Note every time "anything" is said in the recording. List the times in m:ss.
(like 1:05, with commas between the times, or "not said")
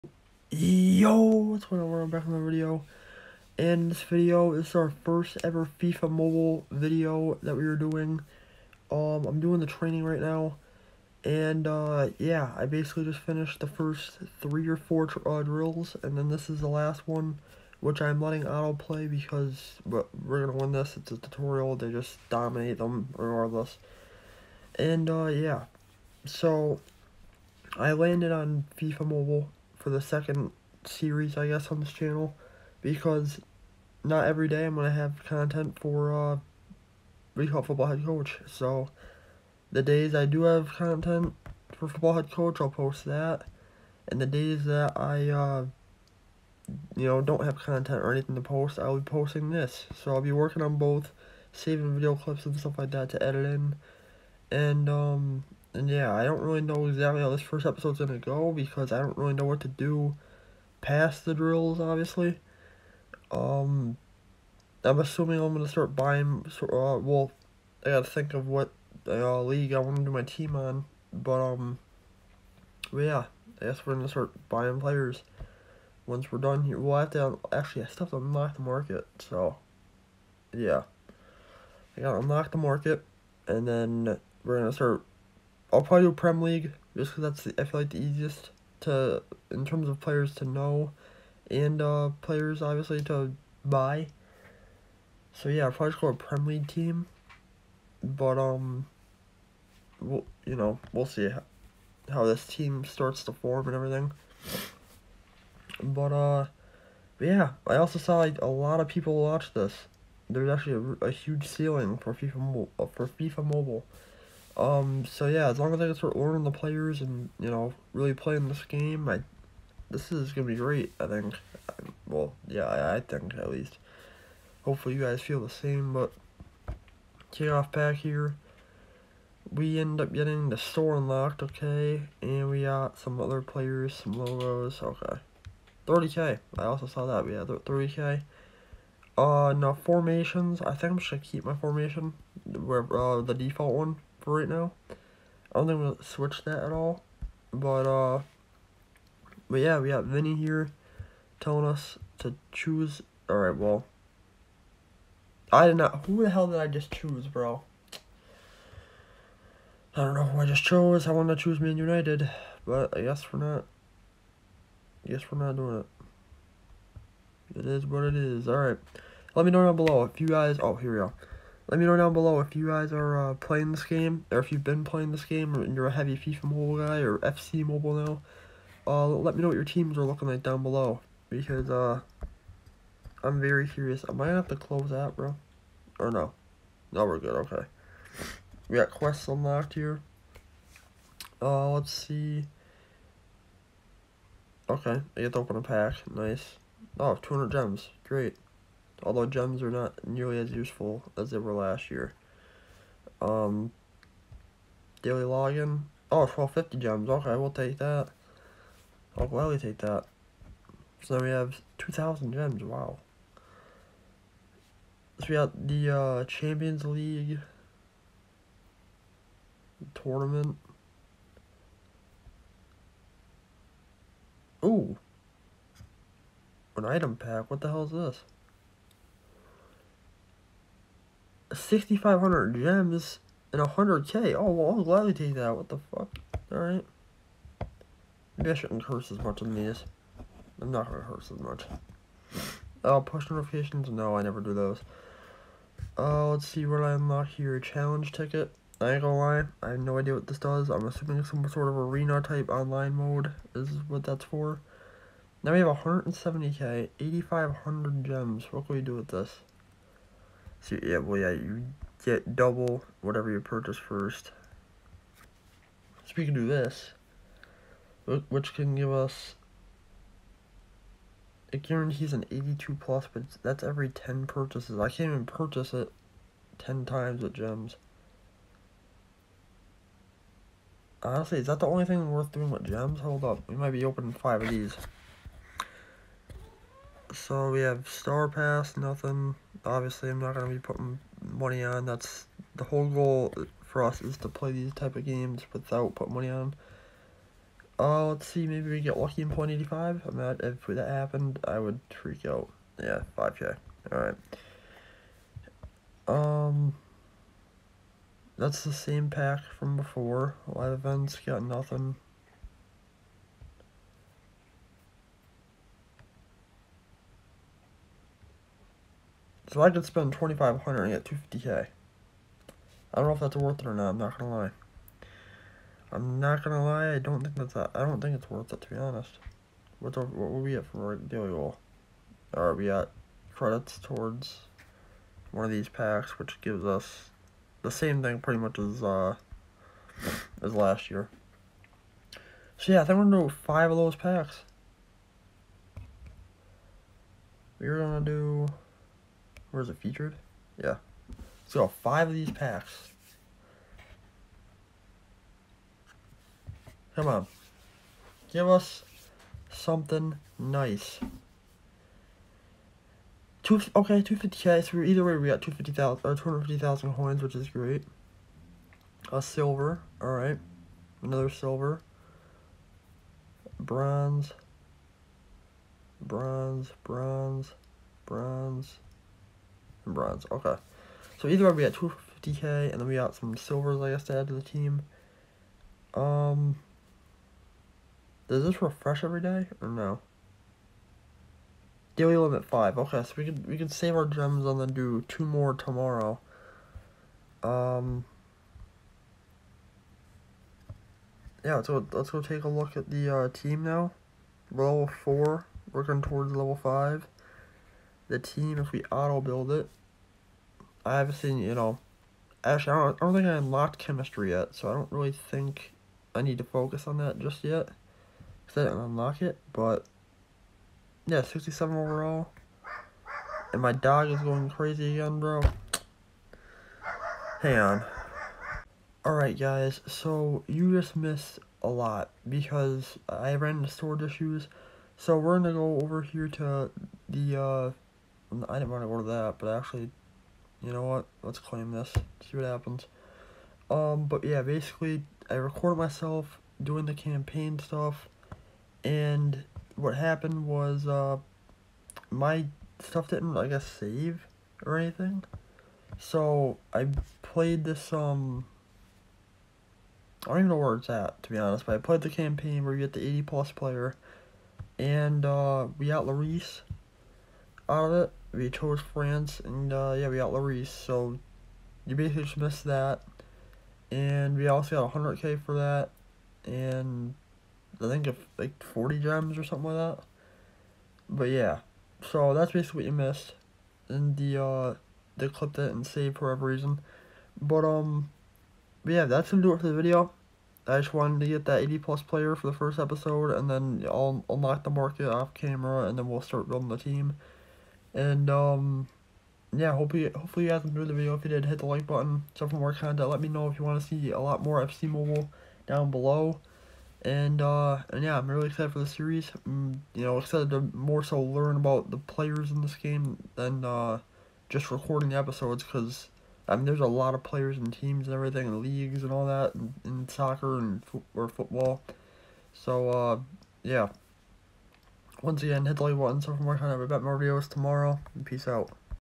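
0:48, 7:34.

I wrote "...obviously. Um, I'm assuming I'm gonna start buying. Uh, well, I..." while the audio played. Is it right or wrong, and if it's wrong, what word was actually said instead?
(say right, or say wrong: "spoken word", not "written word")
right.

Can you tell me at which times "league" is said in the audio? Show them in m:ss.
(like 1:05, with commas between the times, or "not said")
1:09, 1:26, 1:36, 3:36, 8:38.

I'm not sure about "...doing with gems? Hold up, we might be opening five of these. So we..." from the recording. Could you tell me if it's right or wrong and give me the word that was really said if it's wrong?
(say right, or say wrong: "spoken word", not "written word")
right.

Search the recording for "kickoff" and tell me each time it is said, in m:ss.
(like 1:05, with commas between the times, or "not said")
2:07.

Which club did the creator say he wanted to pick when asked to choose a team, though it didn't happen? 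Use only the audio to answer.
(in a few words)
Man United.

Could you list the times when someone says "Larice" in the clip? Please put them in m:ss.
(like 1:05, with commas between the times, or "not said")
7:46, 7:50.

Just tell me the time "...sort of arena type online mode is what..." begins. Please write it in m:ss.
4:11.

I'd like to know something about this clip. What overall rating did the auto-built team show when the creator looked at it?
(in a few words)
67.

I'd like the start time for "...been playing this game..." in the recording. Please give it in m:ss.
2:54.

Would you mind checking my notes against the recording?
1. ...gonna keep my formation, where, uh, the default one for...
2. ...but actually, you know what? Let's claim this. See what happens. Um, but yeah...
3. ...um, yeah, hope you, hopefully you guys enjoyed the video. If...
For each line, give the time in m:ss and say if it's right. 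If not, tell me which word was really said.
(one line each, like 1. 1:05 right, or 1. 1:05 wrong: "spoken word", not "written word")
1. 2:21 right
2. 7:19 right
3. 8:18 right.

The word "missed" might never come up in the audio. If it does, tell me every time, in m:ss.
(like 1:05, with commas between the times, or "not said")
7:10, 7:52, 8:02.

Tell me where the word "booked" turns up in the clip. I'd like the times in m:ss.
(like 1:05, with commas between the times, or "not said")
not said.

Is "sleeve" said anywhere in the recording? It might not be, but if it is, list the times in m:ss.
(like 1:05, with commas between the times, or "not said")
not said.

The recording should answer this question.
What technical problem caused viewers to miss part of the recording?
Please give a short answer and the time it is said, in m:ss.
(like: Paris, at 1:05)
storage issues, at 7:13.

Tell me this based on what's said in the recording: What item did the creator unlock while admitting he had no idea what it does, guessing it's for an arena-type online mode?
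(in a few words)
Challenge ticket.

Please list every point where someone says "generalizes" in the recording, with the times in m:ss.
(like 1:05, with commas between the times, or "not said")
not said.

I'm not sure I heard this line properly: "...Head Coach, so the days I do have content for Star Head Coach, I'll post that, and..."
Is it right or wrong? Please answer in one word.
wrong.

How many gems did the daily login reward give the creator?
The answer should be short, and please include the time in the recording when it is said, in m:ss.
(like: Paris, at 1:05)
1250, at 3:26.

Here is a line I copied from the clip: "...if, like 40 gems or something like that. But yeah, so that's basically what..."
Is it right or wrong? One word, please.
right.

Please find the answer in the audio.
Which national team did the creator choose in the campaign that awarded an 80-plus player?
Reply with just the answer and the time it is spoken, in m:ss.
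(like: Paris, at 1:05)
France, at 7:48.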